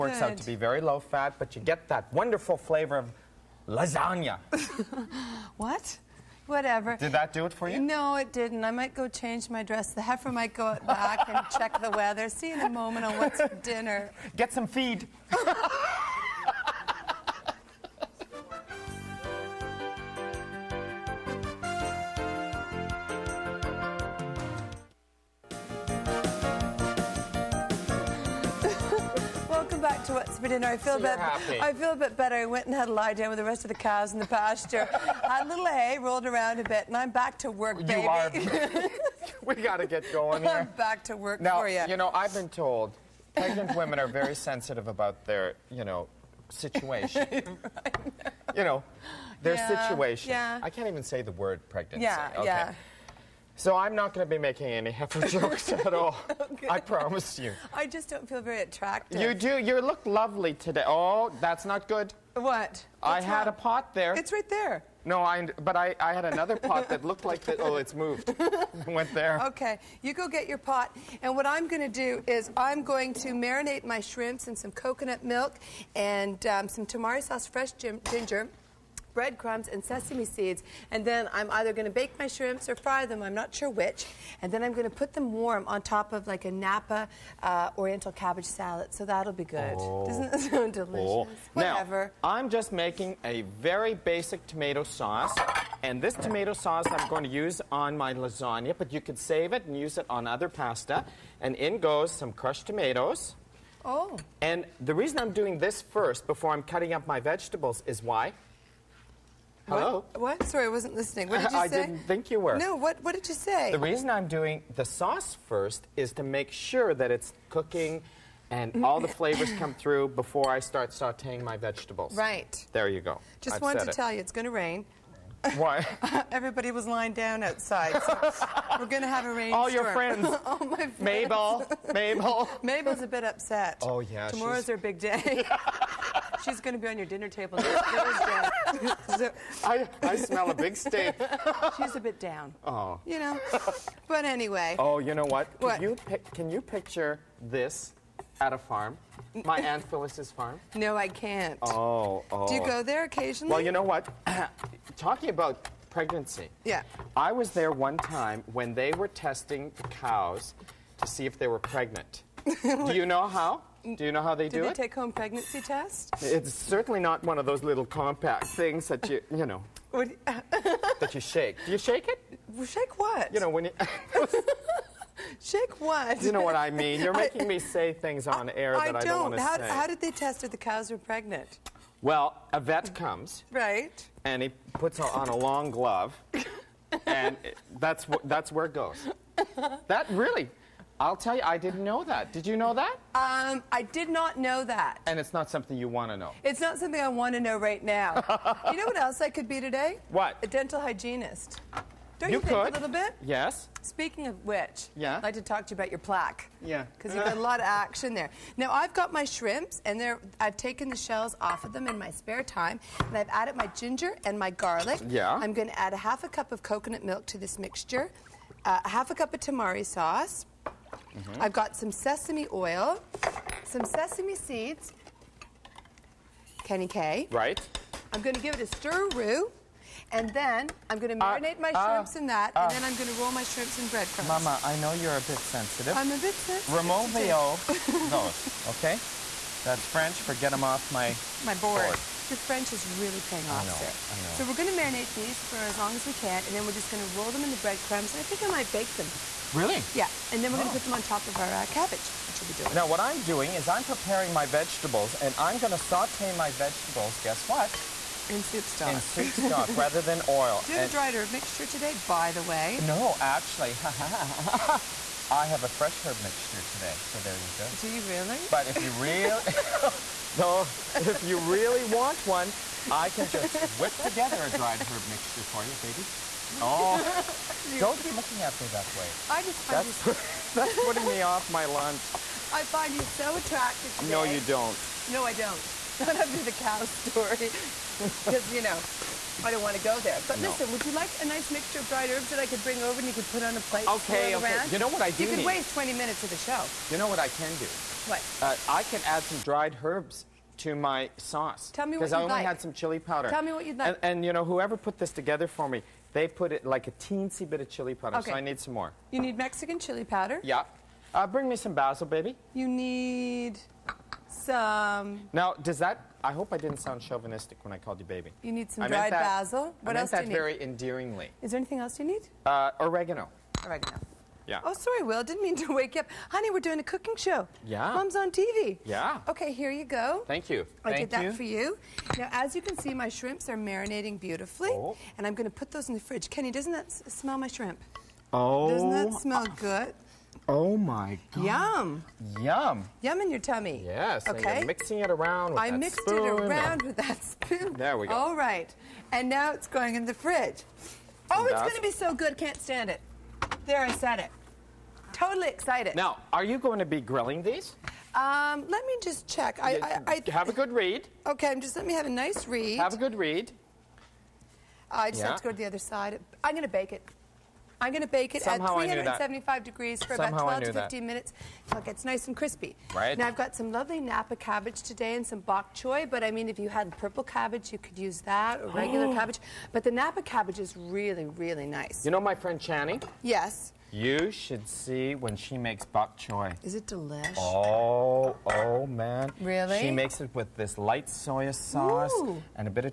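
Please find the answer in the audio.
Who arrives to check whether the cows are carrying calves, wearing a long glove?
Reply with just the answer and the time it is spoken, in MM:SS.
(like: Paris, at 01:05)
a vet, at 03:02.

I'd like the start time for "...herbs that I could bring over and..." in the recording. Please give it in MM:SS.
04:52.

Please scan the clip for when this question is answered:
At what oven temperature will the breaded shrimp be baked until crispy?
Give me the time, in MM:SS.
06:08.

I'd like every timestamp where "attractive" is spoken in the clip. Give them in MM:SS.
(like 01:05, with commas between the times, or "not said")
00:58, 04:43.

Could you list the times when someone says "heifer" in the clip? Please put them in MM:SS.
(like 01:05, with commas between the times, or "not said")
00:10, 00:54.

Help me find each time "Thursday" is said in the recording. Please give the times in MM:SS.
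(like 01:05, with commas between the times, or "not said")
02:17.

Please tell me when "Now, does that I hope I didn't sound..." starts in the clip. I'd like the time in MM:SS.
05:15.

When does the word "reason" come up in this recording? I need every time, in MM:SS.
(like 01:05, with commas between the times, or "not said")
01:44, 01:53.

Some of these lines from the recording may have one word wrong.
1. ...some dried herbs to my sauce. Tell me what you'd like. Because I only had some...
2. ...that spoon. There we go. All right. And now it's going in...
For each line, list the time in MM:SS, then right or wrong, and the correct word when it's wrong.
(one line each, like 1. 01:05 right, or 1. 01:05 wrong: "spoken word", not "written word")
1. 04:59 right
2. 05:46 right.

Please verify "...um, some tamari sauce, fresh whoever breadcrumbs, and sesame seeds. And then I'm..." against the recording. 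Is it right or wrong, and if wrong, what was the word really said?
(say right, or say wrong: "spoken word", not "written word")
wrong: "ginger", not "whoever".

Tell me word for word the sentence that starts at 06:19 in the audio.
But the Napa cabbage is really, really nice.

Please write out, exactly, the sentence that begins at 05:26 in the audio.
Honey, we're doing a cooking show.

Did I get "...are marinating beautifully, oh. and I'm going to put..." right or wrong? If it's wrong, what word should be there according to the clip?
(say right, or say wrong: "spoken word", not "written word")
right.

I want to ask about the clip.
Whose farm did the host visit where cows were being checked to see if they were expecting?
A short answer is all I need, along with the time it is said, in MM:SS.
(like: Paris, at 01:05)
Aunt Phyllis, at 02:29.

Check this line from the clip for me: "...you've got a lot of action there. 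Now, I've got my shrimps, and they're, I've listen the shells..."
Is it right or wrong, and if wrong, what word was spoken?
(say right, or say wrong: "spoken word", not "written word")
wrong: "taken", not "listen".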